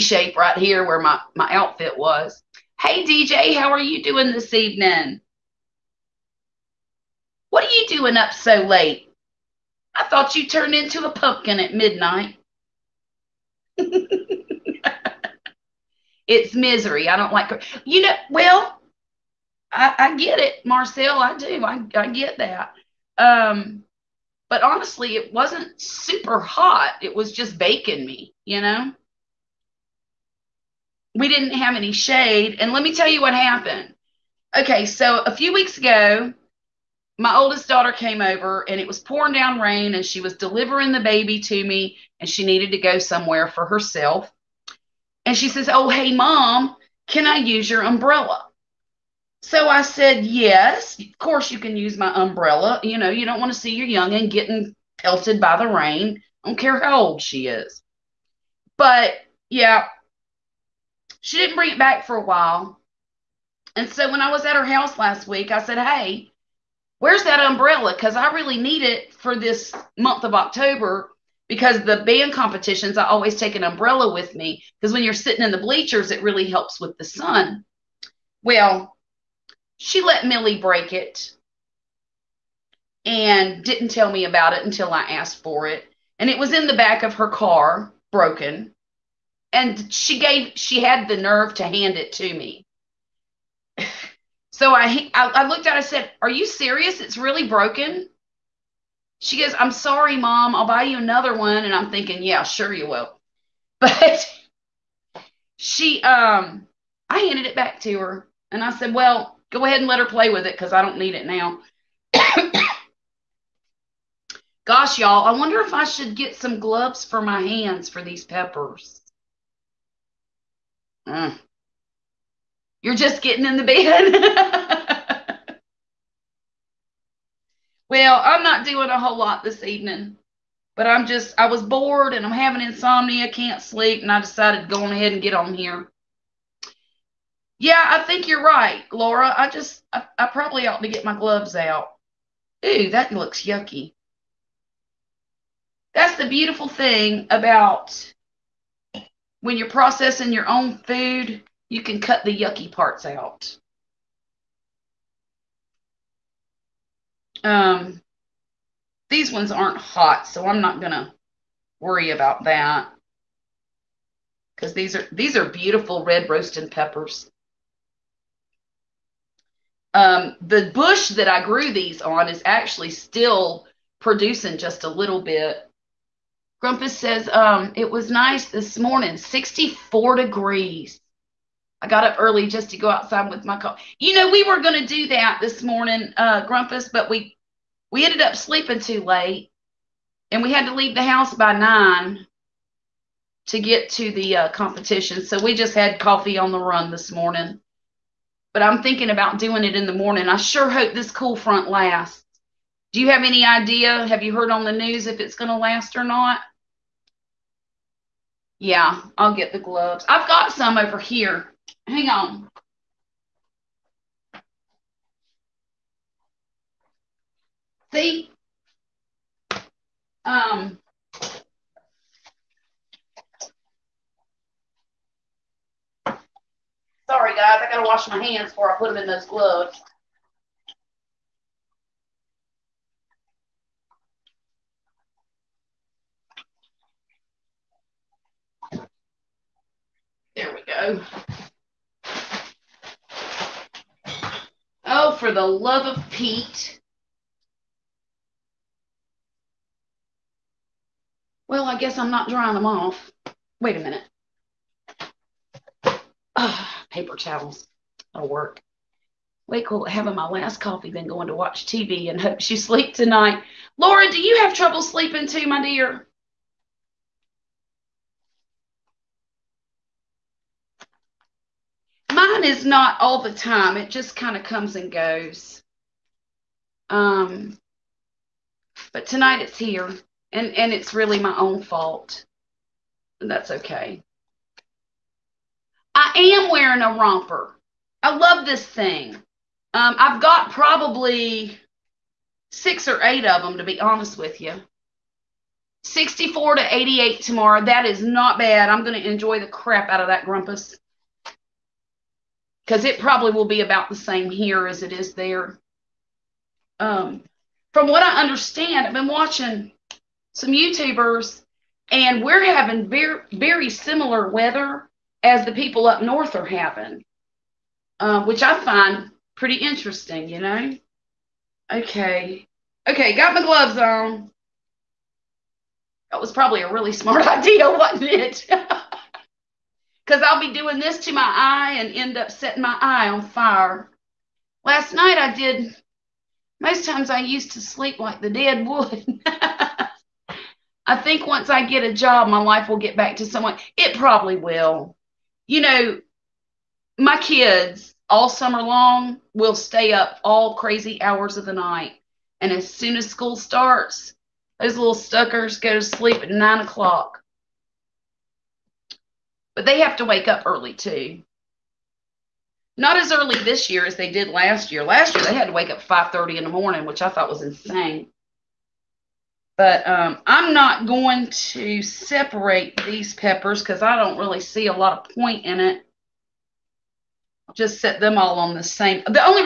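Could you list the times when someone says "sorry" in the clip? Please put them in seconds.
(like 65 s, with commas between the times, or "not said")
99 s, 227 s.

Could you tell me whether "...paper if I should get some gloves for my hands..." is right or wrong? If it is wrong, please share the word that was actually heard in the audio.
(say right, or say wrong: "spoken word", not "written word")
wrong: "wonder", not "paper".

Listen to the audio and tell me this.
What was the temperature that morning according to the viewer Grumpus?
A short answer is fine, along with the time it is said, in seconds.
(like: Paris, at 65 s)
64 degrees, at 179 s.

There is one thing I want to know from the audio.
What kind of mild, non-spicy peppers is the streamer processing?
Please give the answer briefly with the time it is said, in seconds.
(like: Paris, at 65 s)
red roasted peppers, at 166 s.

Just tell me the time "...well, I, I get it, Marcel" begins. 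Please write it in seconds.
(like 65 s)
18 s.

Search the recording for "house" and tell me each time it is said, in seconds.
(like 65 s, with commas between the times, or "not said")
64 s, 191 s.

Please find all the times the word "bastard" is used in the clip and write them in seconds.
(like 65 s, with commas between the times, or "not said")
not said.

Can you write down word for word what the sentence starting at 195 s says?
So we just had coffee on the run this morning.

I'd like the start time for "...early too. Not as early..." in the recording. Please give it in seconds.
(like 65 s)
360 s.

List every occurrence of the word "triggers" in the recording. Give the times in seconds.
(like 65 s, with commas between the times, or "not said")
not said.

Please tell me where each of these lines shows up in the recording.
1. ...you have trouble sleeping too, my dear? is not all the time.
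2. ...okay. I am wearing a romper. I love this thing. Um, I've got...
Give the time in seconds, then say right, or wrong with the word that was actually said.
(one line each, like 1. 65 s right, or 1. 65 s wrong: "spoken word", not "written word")
1. 264 s right
2. 283 s right.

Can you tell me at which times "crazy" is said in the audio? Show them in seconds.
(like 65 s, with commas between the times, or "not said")
350 s.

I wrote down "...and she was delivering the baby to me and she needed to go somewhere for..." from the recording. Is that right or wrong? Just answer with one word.
right.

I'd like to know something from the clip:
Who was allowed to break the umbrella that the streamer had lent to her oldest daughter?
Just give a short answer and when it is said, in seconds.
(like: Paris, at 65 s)
Millie, at 80 s.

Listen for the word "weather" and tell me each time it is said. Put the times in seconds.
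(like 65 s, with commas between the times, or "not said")
314 s.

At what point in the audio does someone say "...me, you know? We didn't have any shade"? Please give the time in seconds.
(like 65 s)
28 s.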